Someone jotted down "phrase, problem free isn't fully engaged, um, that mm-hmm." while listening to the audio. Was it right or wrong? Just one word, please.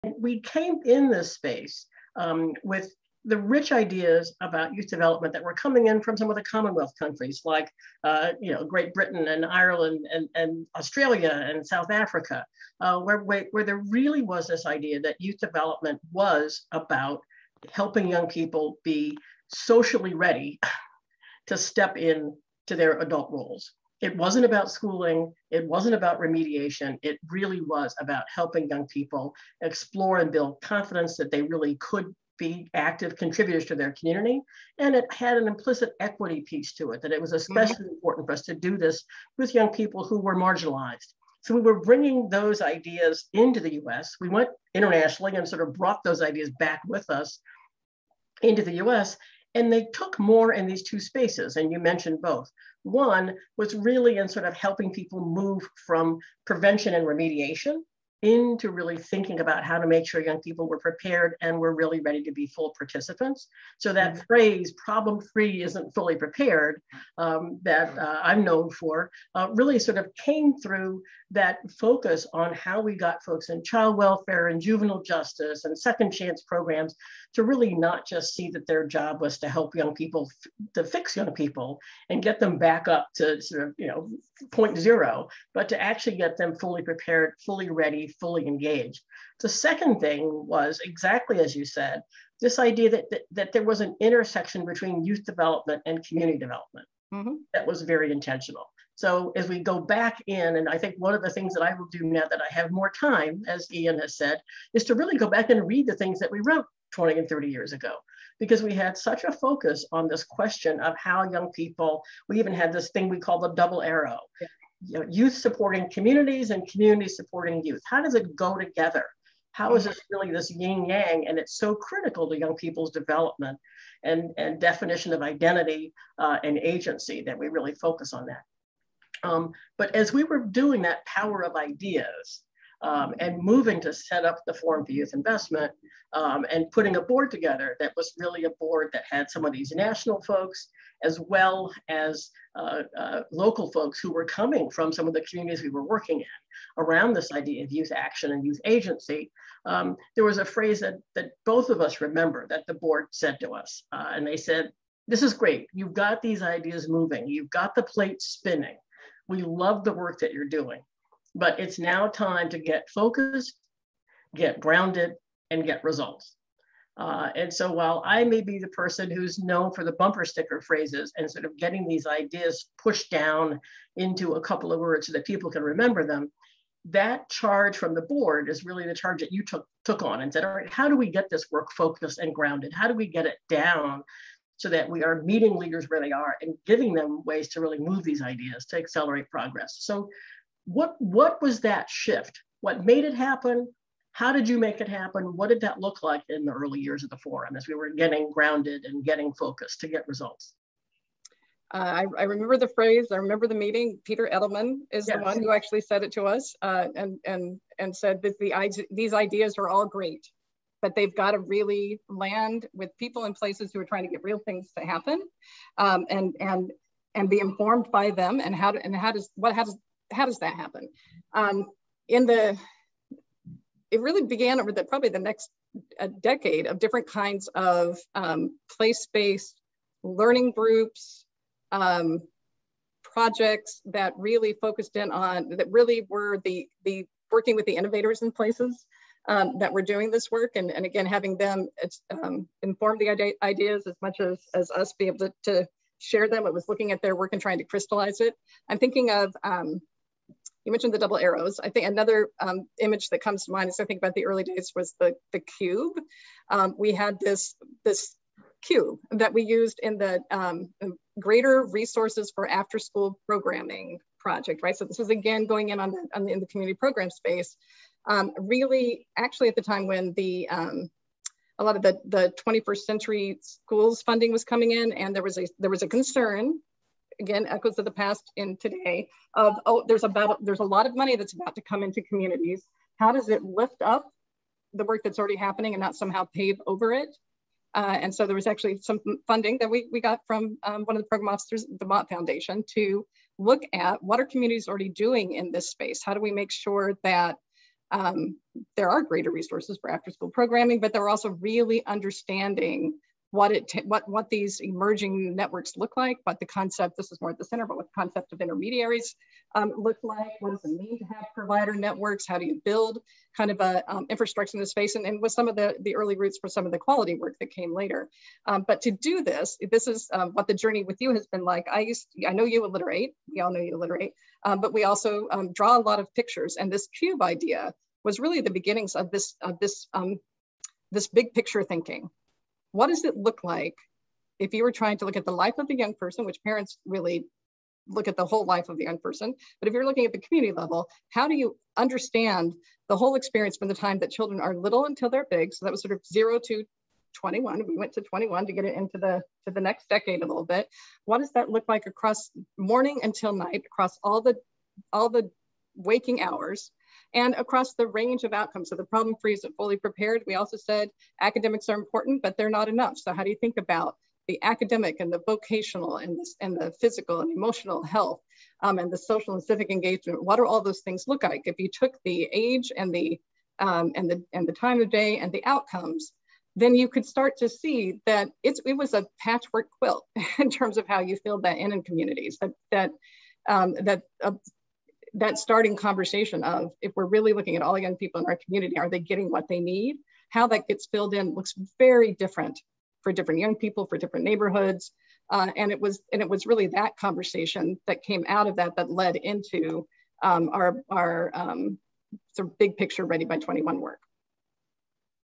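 wrong.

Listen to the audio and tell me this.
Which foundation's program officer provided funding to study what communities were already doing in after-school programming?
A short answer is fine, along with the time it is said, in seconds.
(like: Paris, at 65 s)
Mott Foundation, at 291 s.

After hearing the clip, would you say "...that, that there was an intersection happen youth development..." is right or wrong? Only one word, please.
wrong.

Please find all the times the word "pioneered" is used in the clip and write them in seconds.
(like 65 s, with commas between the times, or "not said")
not said.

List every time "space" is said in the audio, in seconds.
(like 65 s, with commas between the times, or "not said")
1 s, 51 s, 267 s, 295 s, 314 s.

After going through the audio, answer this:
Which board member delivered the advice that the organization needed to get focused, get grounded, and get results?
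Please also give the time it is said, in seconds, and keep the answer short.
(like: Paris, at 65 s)
Peter Edelman, at 204 s.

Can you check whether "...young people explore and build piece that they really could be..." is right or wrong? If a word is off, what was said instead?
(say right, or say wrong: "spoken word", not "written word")
wrong: "confidence", not "piece".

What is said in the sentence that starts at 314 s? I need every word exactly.
And, and with some of the the early roots for some of the quality work that came later.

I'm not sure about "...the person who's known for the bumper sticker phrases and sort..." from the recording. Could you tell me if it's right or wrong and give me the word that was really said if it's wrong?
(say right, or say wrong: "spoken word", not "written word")
right.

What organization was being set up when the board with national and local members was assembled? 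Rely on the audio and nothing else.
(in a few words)
Forum for Youth Investment.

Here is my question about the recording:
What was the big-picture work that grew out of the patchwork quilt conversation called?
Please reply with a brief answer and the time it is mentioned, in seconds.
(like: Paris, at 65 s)
Ready by 21, at 403 s.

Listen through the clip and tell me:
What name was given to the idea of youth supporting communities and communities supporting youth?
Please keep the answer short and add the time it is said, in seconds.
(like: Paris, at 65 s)
double arrow, at 113 s.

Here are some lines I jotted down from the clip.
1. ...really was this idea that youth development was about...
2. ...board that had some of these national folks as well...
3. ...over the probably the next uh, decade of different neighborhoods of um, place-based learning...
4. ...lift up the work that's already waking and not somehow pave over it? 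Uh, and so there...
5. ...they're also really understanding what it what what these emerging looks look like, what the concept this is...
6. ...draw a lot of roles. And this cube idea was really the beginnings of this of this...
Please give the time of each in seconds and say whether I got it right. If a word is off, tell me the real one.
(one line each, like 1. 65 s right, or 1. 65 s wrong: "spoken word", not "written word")
1. 13 s right
2. 138 s right
3. 224 s wrong: "kinds", not "neighborhoods"
4. 283 s wrong: "happening", not "waking"
5. 300 s wrong: "networks", not "looks"
6. 325 s wrong: "pictures", not "roles".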